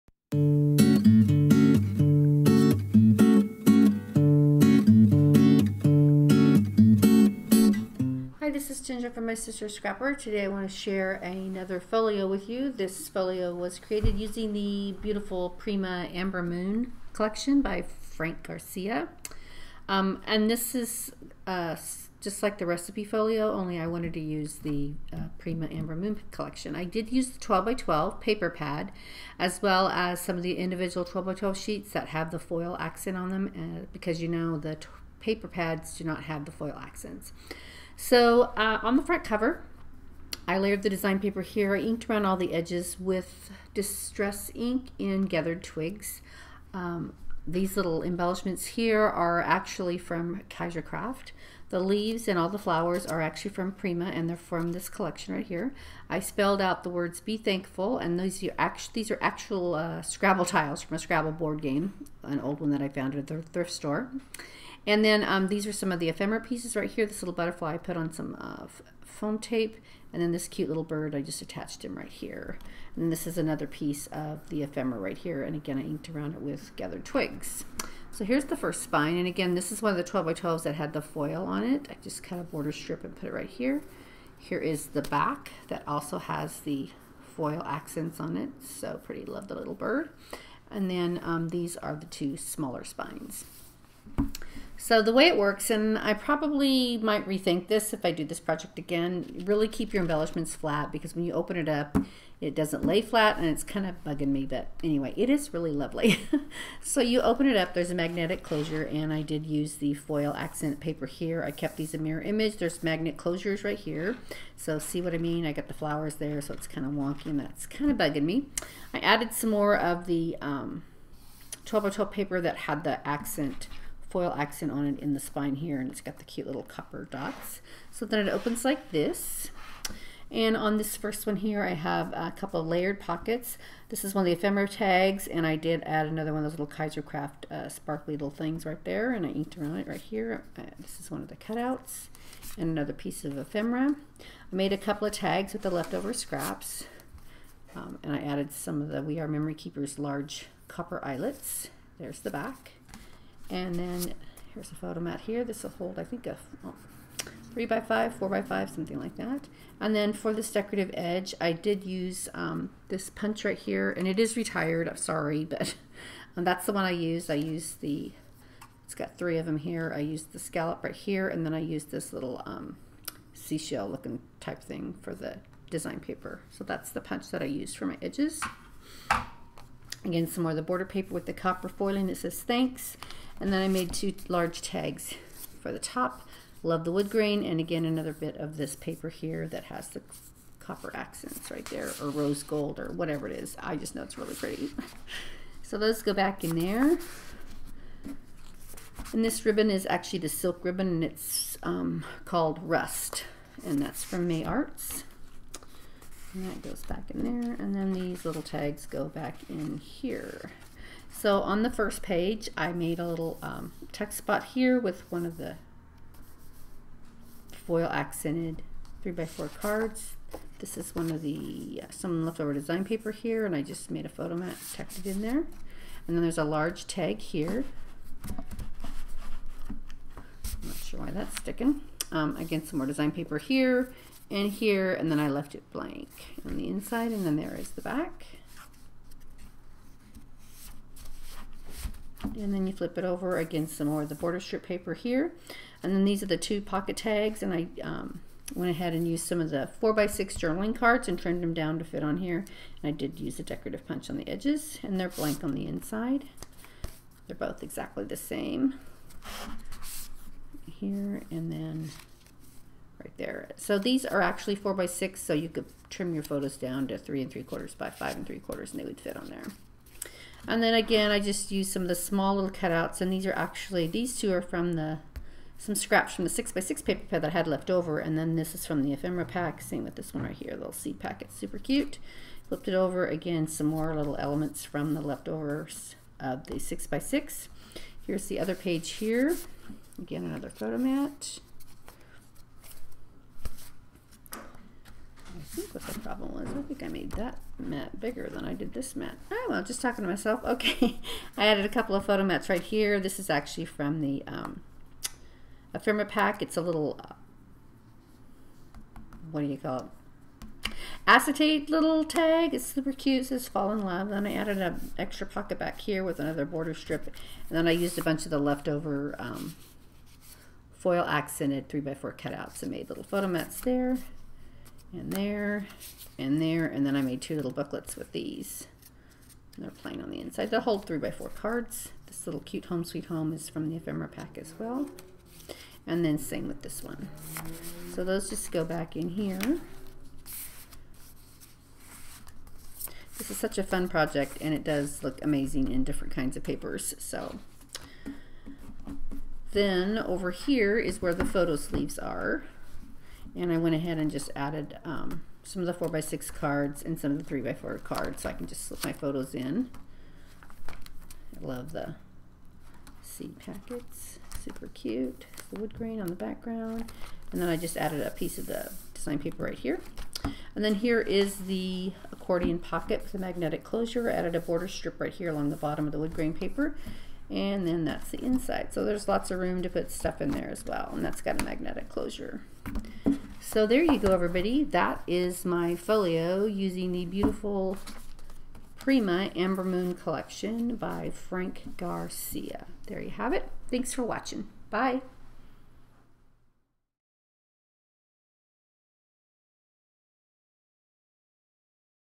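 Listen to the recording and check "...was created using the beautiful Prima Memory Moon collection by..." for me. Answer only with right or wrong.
wrong.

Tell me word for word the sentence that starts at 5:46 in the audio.
So then over here is where the photo sleeves are.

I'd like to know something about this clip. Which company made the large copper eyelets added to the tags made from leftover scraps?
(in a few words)
We Are Memory Keepers.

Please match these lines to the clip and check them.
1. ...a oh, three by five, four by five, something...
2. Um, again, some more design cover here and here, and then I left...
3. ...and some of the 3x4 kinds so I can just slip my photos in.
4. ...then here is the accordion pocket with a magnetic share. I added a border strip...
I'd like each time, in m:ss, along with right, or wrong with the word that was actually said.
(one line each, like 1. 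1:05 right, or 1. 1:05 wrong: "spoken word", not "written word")
1. 2:36 right
2. 3:52 wrong: "paper", not "cover"
3. 5:56 wrong: "cards", not "kinds"
4. 6:10 wrong: "closure", not "share".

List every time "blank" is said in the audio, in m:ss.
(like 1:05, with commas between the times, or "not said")
3:55, 4:15.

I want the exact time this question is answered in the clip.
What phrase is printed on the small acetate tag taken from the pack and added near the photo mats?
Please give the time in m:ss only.
5:13.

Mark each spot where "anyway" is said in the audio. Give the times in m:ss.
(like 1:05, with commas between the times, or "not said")
1:44.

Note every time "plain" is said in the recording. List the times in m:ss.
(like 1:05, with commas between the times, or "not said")
5:29.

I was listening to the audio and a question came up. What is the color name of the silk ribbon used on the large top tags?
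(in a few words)
Rust.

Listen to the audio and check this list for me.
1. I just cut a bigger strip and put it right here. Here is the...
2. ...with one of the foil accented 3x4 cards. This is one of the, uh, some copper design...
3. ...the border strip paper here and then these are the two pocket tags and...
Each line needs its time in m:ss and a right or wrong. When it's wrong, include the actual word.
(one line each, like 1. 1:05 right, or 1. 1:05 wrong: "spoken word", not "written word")
1. 1:21 wrong: "border", not "bigger"
2. 3:34 wrong: "leftover", not "copper"
3. 4:04 right.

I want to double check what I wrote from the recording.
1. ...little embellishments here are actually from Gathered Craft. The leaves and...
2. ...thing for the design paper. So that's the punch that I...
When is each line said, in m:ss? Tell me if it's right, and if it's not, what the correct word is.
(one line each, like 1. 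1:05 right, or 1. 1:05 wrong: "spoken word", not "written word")
1. 0:47 wrong: "Kaiser", not "Gathered"
2. 2:54 right.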